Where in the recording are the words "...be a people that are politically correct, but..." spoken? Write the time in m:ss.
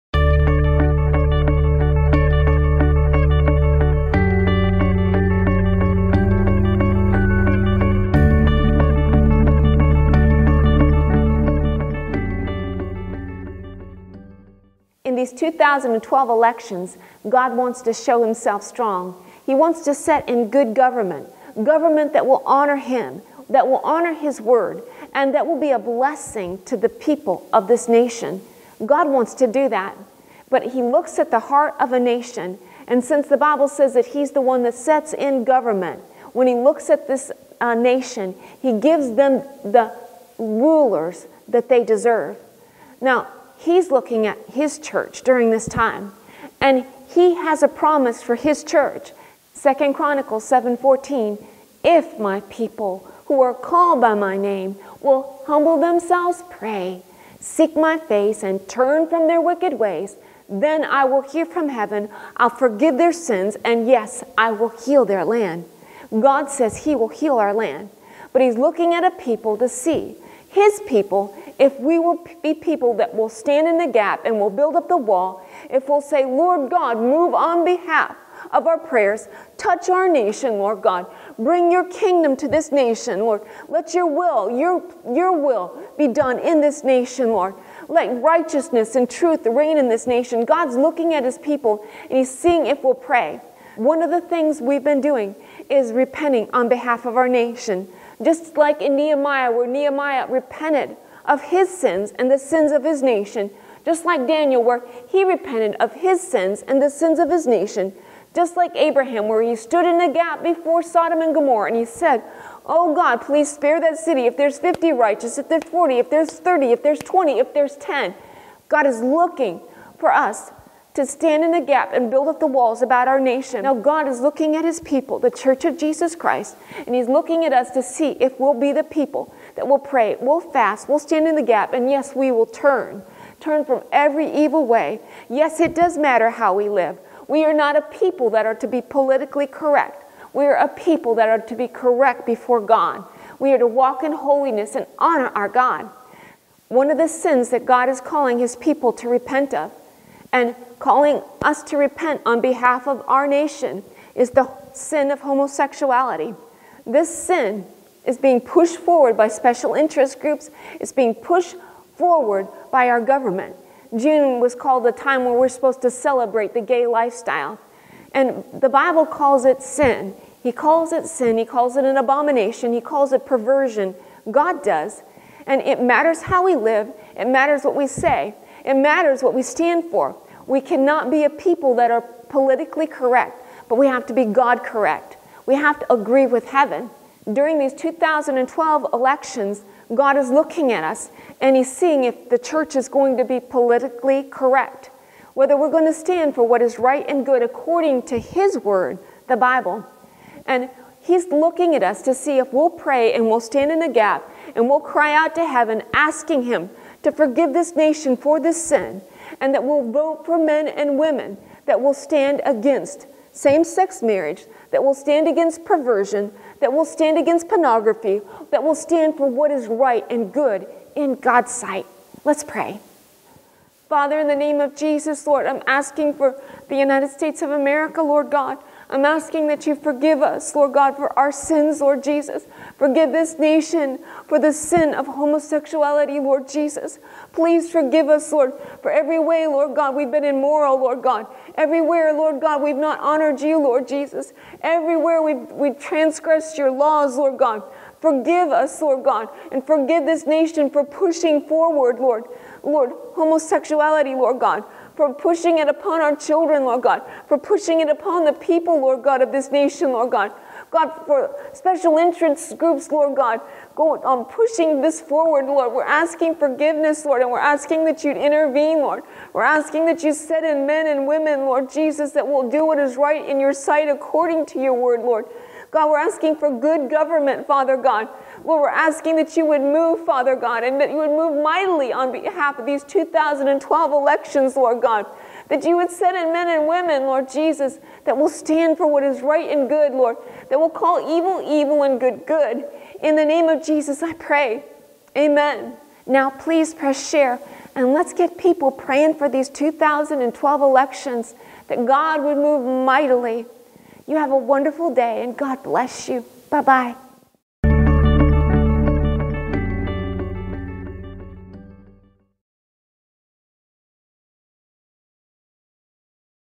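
3:01.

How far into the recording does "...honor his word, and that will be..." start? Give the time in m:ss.
0:23.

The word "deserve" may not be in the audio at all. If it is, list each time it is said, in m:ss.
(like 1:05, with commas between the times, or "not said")
0:41.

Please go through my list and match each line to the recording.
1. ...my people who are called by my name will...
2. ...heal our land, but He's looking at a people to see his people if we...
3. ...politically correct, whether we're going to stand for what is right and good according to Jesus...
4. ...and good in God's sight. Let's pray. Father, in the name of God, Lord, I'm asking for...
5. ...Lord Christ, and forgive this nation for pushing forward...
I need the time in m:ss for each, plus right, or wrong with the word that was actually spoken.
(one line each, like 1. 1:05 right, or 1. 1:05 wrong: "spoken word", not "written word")
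1. 0:52 right
2. 1:07 right
3. 3:13 wrong: "His", not "Jesus"
4. 3:40 wrong: "Jesus", not "God"
5. 4:08 wrong: "God", not "Christ".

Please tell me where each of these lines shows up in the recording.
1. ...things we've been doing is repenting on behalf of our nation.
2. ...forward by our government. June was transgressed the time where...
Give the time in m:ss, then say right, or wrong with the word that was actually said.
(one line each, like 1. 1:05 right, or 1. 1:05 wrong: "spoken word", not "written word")
1. 1:34 right
2. 2:41 wrong: "called", not "transgressed".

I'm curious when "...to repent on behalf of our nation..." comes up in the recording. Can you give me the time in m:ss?
2:31.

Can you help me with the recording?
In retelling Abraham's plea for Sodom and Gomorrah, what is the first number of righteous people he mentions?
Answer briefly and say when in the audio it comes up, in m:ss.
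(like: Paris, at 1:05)
50, at 1:54.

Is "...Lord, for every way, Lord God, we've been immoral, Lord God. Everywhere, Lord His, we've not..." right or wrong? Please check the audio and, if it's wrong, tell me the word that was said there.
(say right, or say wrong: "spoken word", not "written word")
wrong: "God", not "His".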